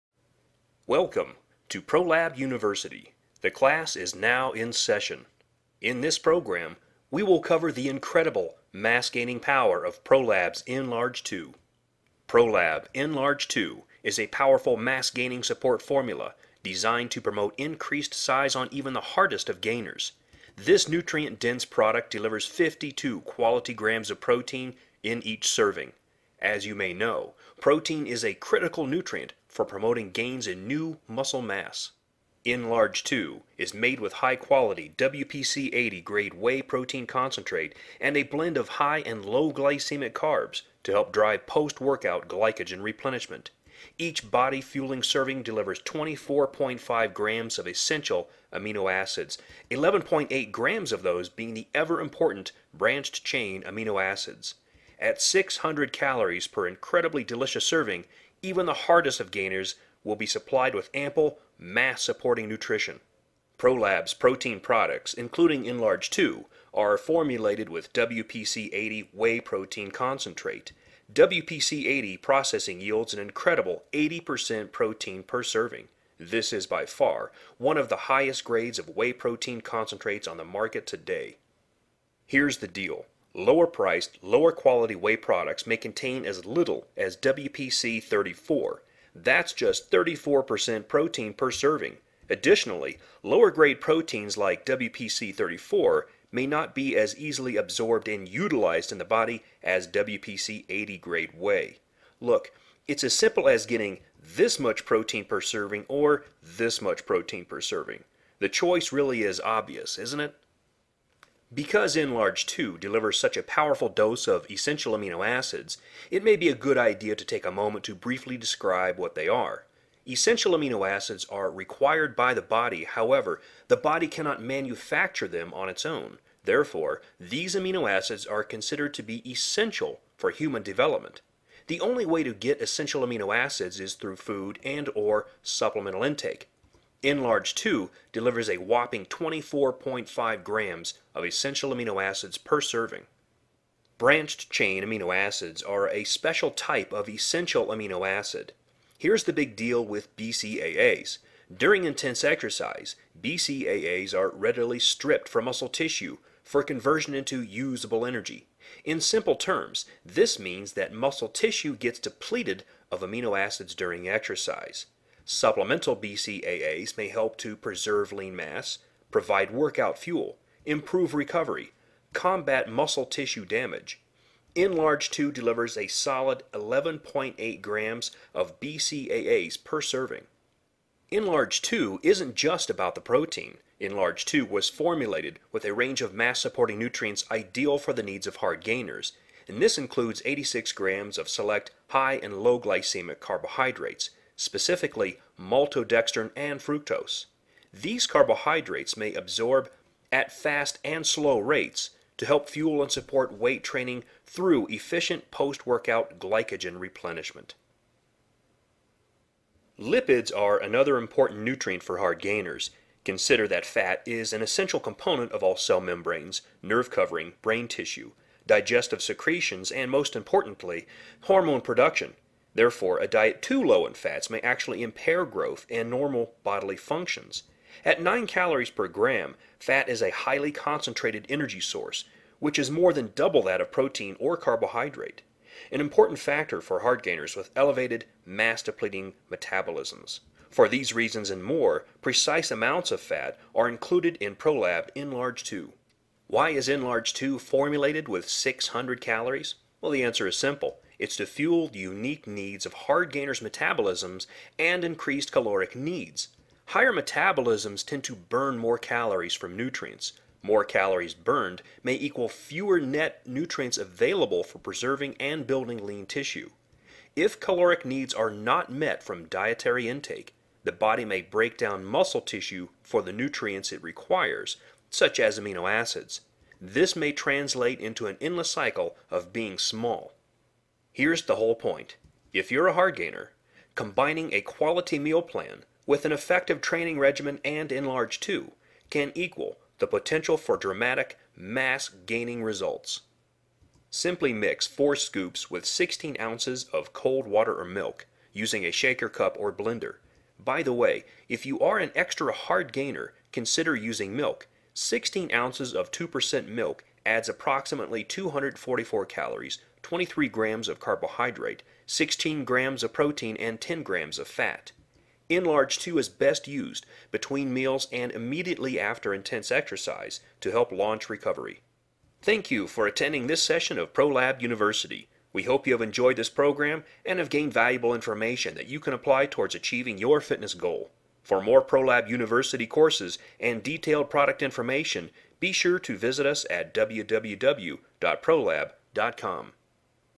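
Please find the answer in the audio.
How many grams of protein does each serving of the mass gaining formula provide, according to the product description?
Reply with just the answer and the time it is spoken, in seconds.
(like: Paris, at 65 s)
52 grams, at 22 s.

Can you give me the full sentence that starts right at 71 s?
WPC-80 processing yields an incredible 80% protein per serving.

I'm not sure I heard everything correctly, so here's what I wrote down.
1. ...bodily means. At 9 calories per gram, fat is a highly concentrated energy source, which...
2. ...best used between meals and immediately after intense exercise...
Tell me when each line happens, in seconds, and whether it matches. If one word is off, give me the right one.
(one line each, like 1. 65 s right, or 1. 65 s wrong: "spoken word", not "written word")
1. 226 s wrong: "functions", not "means"
2. 316 s right.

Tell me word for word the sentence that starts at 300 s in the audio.
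By the way, if you are an extra hard gainer, consider using milk.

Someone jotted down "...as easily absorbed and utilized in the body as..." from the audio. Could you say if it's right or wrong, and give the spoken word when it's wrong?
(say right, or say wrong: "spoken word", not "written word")
right.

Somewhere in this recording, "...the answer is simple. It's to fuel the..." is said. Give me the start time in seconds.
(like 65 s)
249 s.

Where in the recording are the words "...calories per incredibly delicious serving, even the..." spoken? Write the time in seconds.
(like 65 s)
55 s.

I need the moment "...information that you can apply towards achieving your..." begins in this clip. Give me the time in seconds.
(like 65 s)
327 s.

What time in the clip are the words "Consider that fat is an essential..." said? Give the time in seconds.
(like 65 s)
213 s.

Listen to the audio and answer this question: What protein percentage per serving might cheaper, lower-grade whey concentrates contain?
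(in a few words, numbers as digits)
34%.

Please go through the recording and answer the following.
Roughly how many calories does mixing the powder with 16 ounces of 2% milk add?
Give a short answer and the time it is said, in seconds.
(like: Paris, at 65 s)
244, at 308 s.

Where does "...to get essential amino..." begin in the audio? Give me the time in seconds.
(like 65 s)
132 s.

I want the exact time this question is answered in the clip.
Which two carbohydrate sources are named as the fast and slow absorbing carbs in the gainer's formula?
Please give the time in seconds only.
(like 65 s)
195 s.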